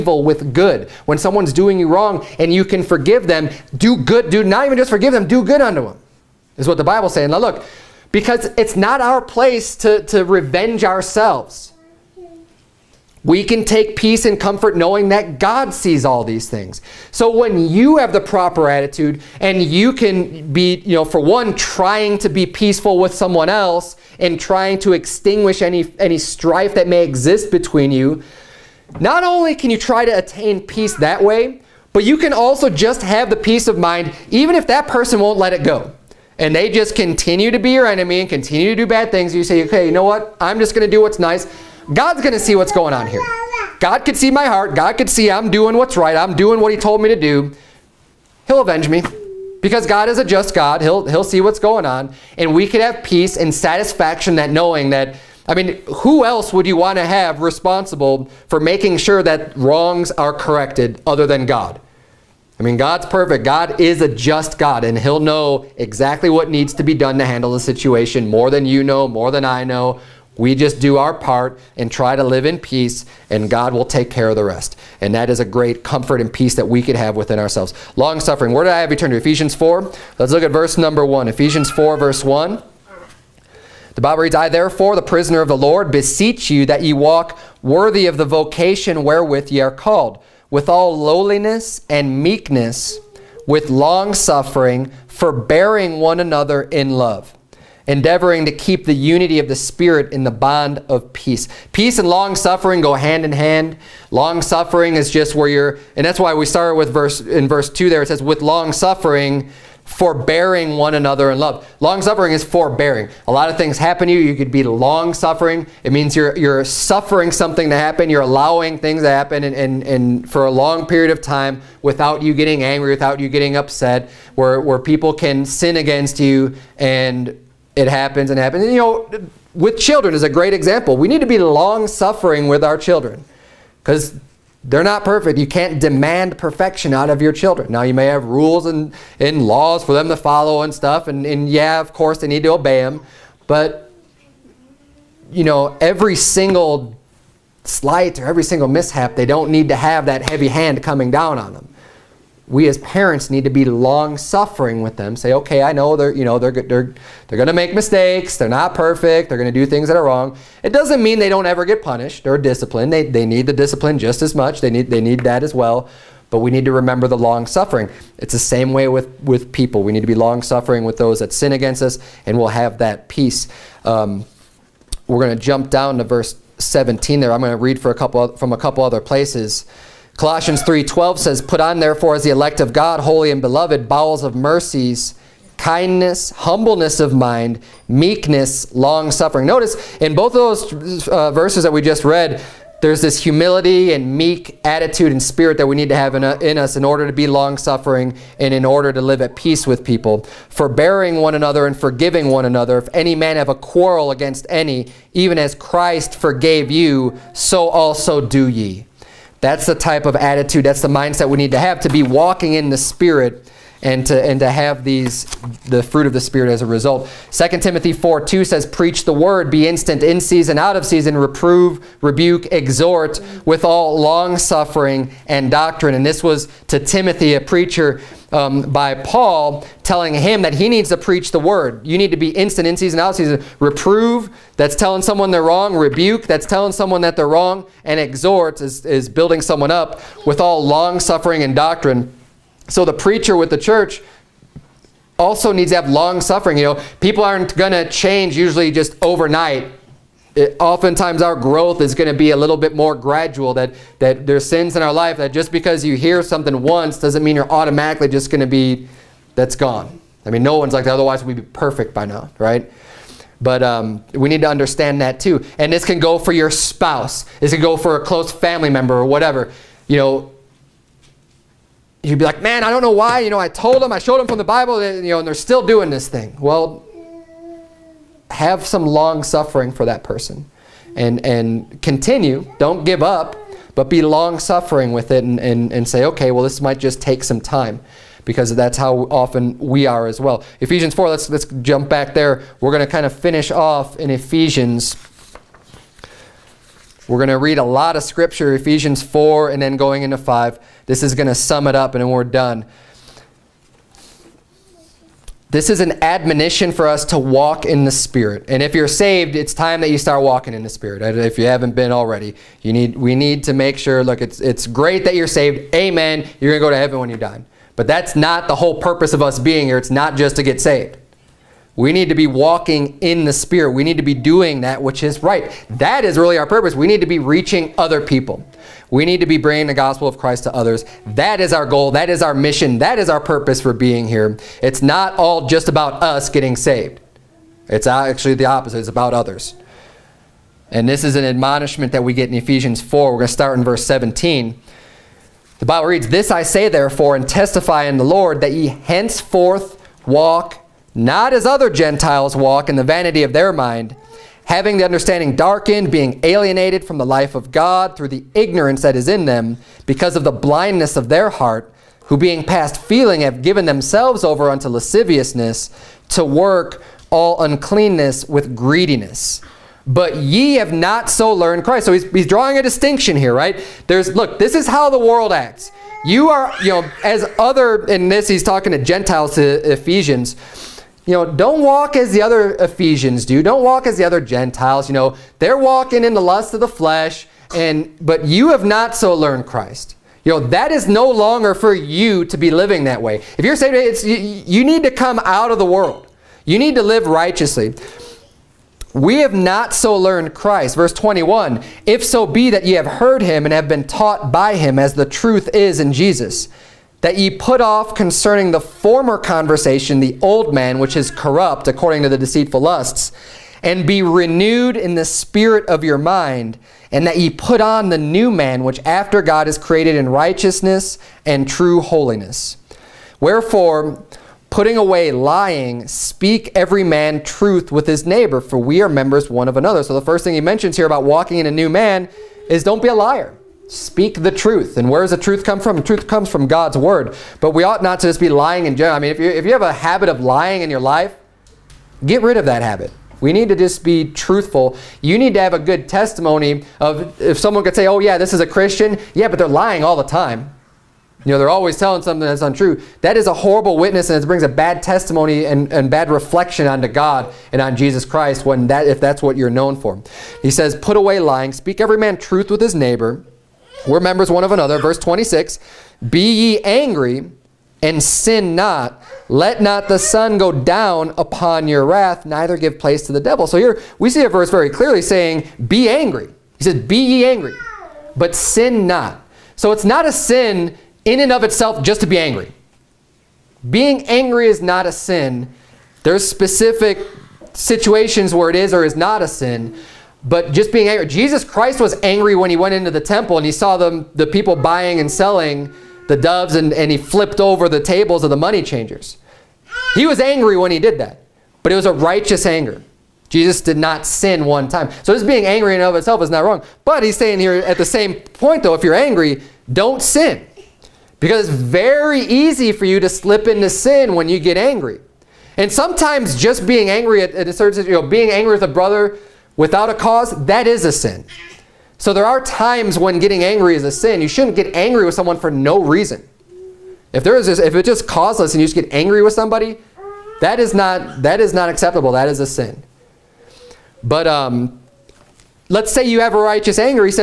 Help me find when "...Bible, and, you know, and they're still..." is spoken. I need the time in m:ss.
4:34.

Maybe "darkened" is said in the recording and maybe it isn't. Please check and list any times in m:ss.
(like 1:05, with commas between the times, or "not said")
5:55.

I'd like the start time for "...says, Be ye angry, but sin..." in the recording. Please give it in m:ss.
7:56.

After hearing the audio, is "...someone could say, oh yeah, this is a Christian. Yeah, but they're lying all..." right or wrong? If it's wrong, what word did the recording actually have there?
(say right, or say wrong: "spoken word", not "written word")
right.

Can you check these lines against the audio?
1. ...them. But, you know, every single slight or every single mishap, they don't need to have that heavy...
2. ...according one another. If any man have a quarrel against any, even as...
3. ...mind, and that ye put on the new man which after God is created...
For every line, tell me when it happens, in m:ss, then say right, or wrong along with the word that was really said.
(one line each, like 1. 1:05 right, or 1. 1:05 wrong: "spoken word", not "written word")
1. 2:22 right
2. 3:21 wrong: "forgiving", not "according"
3. 6:55 right.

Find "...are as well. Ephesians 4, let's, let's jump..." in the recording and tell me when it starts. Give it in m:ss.
4:49.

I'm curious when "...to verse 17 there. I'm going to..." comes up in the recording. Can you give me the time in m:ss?
2:55.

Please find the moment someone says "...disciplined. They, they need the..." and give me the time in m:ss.
2:42.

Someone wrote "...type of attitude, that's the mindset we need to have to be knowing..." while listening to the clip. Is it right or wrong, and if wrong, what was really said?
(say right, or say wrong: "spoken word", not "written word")
wrong: "walking", not "knowing".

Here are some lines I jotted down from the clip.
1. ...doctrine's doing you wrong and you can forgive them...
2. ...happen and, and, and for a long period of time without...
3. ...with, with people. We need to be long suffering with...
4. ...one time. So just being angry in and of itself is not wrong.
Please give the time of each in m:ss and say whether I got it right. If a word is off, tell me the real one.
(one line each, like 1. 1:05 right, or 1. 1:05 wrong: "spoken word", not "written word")
1. 0:01 wrong: "someone", not "doctrine"
2. 1:59 right
3. 2:48 right
4. 8:24 right.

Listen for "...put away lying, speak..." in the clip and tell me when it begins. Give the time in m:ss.
7:40.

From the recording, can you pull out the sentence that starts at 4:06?
You know, people aren't going to change usually just overnight.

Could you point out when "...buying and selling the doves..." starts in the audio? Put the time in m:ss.
8:14.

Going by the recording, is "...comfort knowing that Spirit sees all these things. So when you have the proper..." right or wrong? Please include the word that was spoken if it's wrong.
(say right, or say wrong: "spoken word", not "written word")
wrong: "God", not "Spirit".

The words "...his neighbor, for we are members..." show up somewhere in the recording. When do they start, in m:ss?
7:07.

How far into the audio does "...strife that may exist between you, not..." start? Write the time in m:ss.
0:26.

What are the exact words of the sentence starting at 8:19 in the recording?
He was angry when he did that.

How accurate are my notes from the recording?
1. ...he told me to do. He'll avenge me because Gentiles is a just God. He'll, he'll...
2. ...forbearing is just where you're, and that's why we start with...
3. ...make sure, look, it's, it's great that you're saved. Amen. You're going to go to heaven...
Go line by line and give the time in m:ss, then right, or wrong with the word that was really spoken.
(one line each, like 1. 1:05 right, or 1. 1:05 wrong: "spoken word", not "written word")
1. 0:46 wrong: "God", not "Gentiles"
2. 1:44 wrong: "suffering", not "forbearing"
3. 5:13 right.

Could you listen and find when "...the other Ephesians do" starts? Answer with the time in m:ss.
6:22.